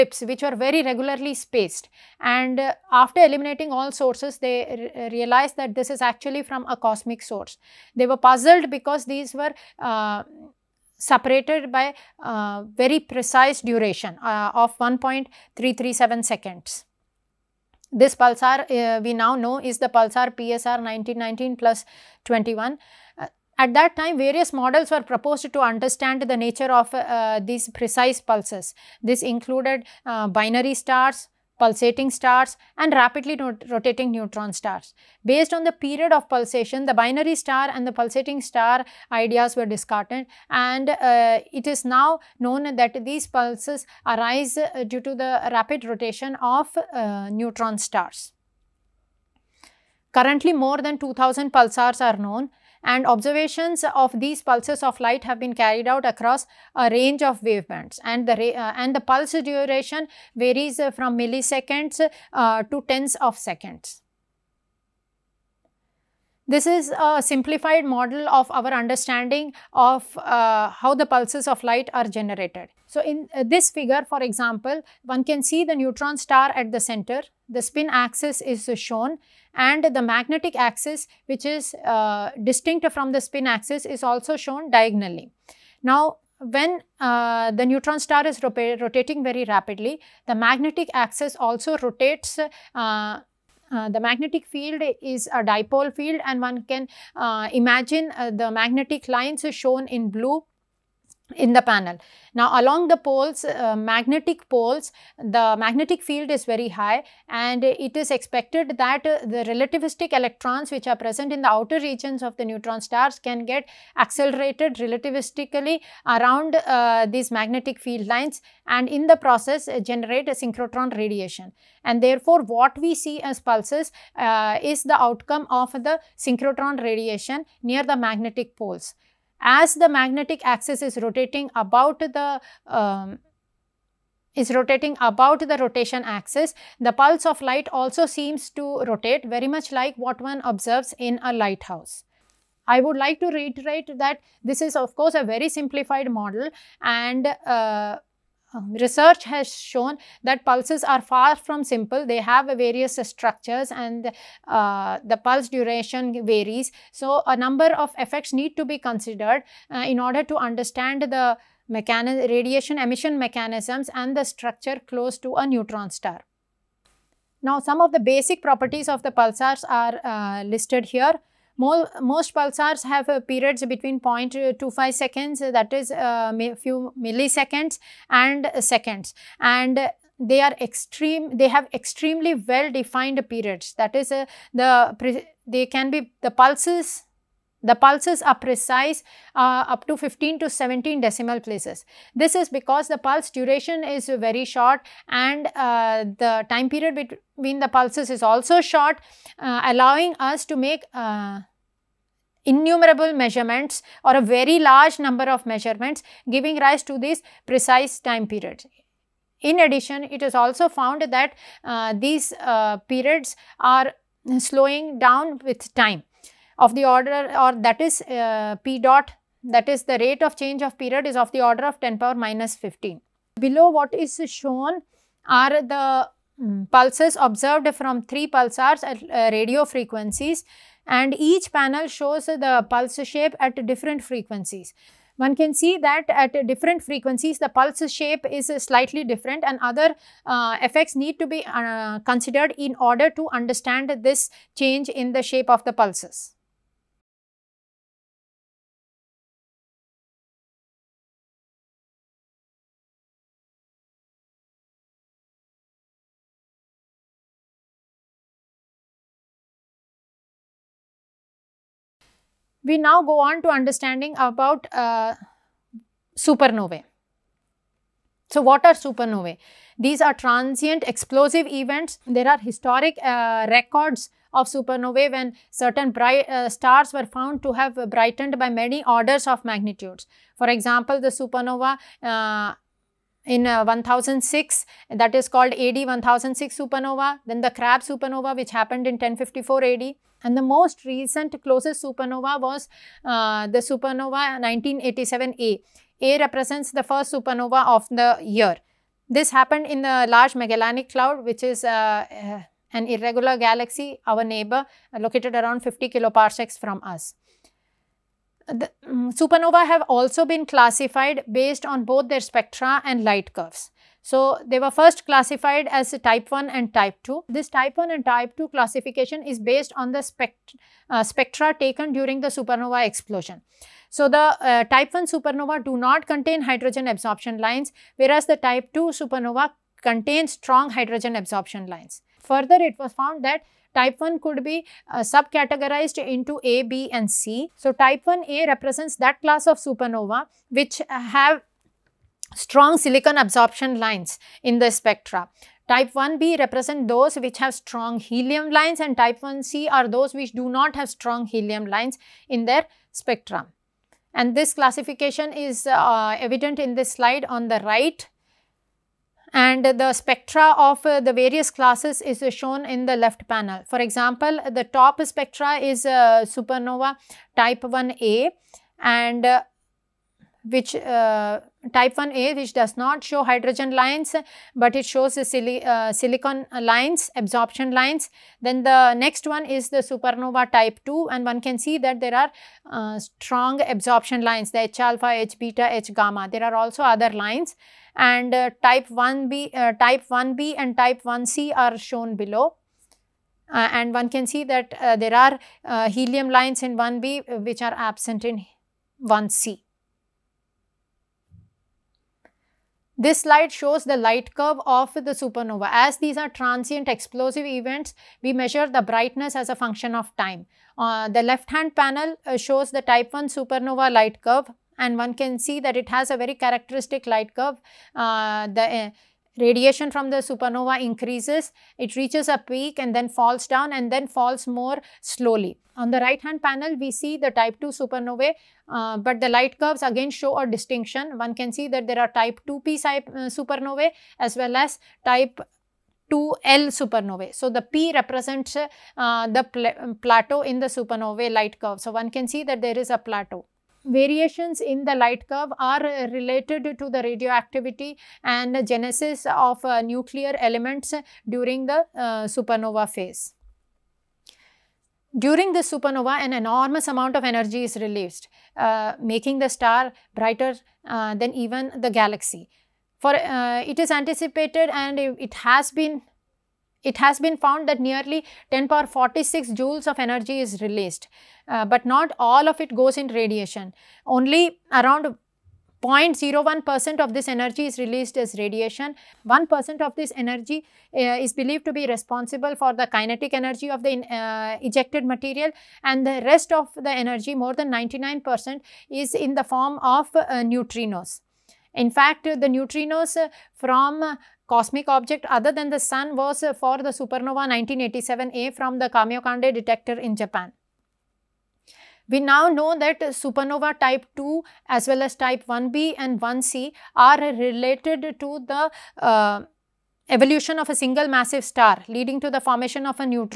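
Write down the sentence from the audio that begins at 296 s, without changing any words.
A represents the first supernova of the year.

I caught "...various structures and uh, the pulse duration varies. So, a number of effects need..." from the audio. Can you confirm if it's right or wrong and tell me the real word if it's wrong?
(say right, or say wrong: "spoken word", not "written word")
right.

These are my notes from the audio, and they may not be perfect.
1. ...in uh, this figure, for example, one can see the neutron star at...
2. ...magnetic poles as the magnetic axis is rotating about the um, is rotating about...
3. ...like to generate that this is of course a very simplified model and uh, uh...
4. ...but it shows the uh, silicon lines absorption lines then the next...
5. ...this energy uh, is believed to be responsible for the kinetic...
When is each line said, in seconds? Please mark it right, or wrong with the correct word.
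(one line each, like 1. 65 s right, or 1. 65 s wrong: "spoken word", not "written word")
1. 73 s right
2. 127 s right
3. 142 s wrong: "reiterate", not "generate"
4. 374 s right
5. 479 s right.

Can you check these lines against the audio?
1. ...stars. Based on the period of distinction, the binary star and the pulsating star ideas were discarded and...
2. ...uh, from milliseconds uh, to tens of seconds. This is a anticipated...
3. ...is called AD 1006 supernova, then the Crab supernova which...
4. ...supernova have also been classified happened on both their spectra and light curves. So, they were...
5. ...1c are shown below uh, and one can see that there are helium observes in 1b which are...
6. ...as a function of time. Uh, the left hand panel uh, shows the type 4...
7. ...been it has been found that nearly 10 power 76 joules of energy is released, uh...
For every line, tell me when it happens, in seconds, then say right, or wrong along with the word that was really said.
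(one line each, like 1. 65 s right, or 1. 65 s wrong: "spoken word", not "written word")
1. 34 s wrong: "pulsation", not "distinction"
2. 60 s wrong: "simplified", not "anticipated"
3. 285 s right
4. 309 s wrong: "based", not "happened"
5. 391 s wrong: "lines", not "observes"
6. 409 s wrong: "1", not "4"
7. 465 s wrong: "46", not "76".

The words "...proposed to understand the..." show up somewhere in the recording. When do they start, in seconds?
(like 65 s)
25 s.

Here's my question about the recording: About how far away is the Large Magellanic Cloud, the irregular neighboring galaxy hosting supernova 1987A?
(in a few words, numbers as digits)
50 kiloparsecs.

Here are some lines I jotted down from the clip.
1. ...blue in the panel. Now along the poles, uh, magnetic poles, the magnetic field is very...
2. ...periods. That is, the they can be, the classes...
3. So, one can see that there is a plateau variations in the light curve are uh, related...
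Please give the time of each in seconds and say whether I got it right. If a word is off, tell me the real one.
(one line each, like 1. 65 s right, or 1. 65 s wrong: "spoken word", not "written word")
1. 100 s right
2. 183 s wrong: "pulses", not "classes"
3. 441 s right.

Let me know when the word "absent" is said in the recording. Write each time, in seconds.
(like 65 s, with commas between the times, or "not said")
397 s.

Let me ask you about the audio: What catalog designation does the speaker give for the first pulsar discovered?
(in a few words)
PSR 1919+21.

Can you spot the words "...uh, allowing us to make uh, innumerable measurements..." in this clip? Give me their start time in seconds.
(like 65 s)
199 s.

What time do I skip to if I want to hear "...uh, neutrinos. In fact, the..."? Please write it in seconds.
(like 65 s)
490 s.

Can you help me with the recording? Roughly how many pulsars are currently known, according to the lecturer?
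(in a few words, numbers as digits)
more than 2000.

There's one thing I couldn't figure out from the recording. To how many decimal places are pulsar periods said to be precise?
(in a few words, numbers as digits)
15 to 17.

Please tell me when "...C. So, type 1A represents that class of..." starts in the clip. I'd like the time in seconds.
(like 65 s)
337 s.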